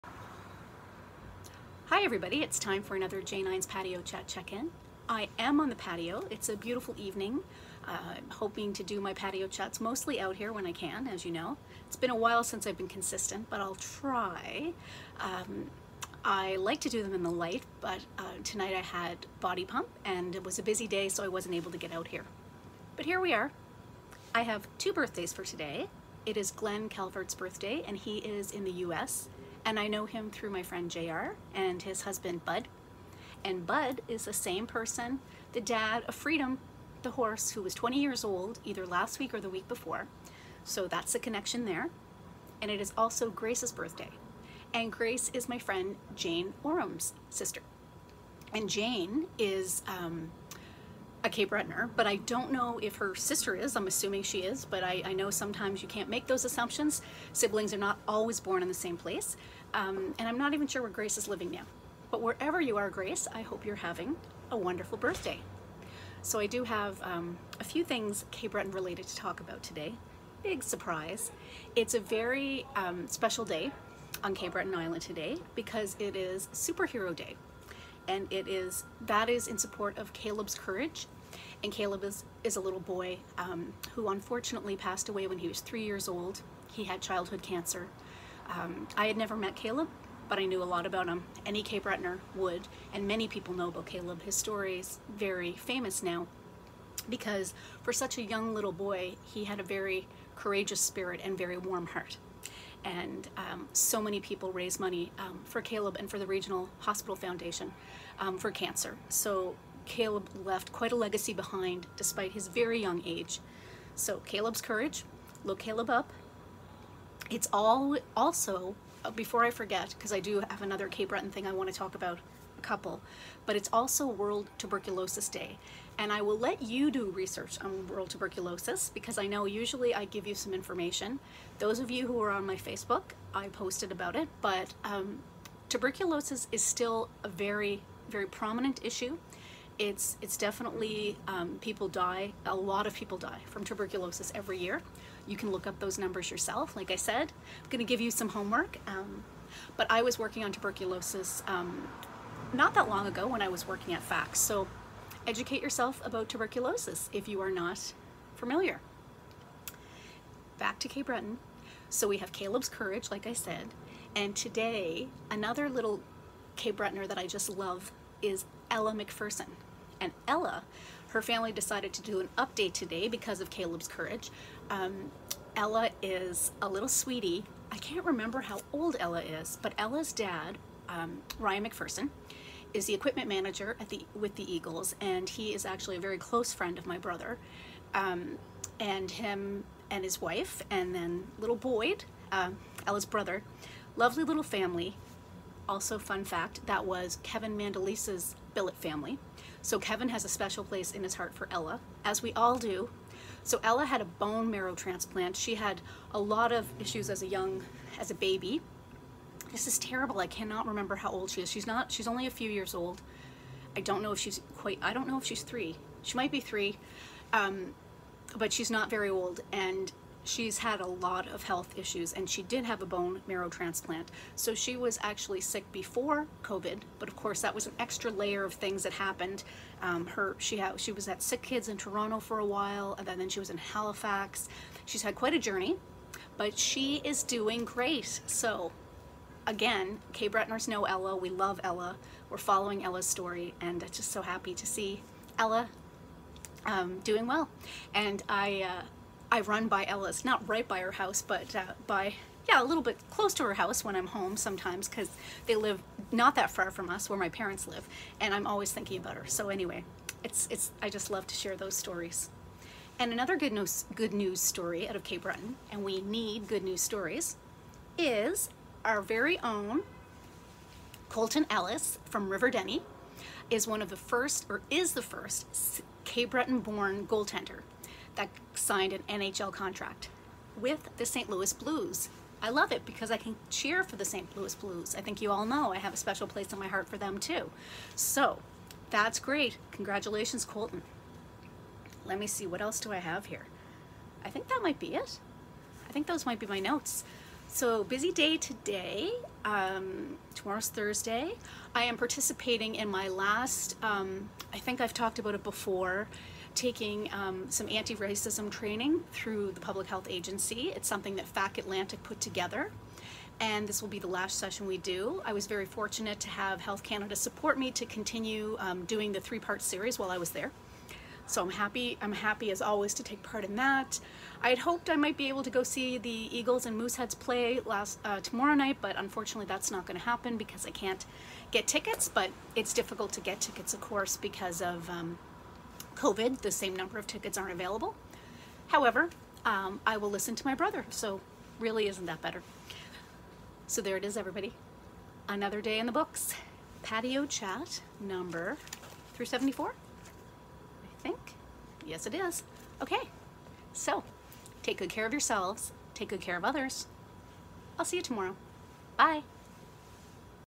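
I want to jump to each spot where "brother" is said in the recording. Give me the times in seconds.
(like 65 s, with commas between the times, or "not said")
186 s, 193 s, 340 s.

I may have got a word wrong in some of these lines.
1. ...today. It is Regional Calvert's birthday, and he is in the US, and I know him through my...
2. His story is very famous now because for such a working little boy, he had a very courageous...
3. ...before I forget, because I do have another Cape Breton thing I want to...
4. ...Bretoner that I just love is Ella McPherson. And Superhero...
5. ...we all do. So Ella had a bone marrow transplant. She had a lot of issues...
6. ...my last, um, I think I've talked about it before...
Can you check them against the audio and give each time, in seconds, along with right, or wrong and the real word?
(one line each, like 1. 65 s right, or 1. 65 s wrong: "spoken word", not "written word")
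1. 25 s wrong: "Glenn", not "Regional"
2. 94 s wrong: "young", not "working"
3. 119 s right
4. 166 s wrong: "Ella", not "Superhero"
5. 202 s right
6. 302 s right.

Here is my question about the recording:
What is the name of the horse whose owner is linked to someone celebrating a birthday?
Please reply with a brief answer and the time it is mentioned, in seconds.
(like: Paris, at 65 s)
Freedom, at 36 s.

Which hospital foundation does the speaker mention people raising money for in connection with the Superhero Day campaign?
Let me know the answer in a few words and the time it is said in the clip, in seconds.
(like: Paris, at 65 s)
Regional Hospital Foundation, at 106 s.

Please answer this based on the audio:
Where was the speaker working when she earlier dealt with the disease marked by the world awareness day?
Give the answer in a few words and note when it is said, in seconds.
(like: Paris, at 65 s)
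FACS, at 154 s.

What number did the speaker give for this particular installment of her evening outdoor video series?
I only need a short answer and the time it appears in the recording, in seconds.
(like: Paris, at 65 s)
374, at 349 s.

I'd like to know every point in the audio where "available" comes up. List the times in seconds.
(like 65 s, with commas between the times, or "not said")
337 s.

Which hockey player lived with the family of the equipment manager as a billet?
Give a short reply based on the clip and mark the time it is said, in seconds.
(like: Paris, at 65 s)
Kevin Mandolese, at 197 s.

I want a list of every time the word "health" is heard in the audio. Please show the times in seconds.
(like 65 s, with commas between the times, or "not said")
221 s, 309 s, 316 s.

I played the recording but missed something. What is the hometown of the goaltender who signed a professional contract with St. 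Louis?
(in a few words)
River Denys.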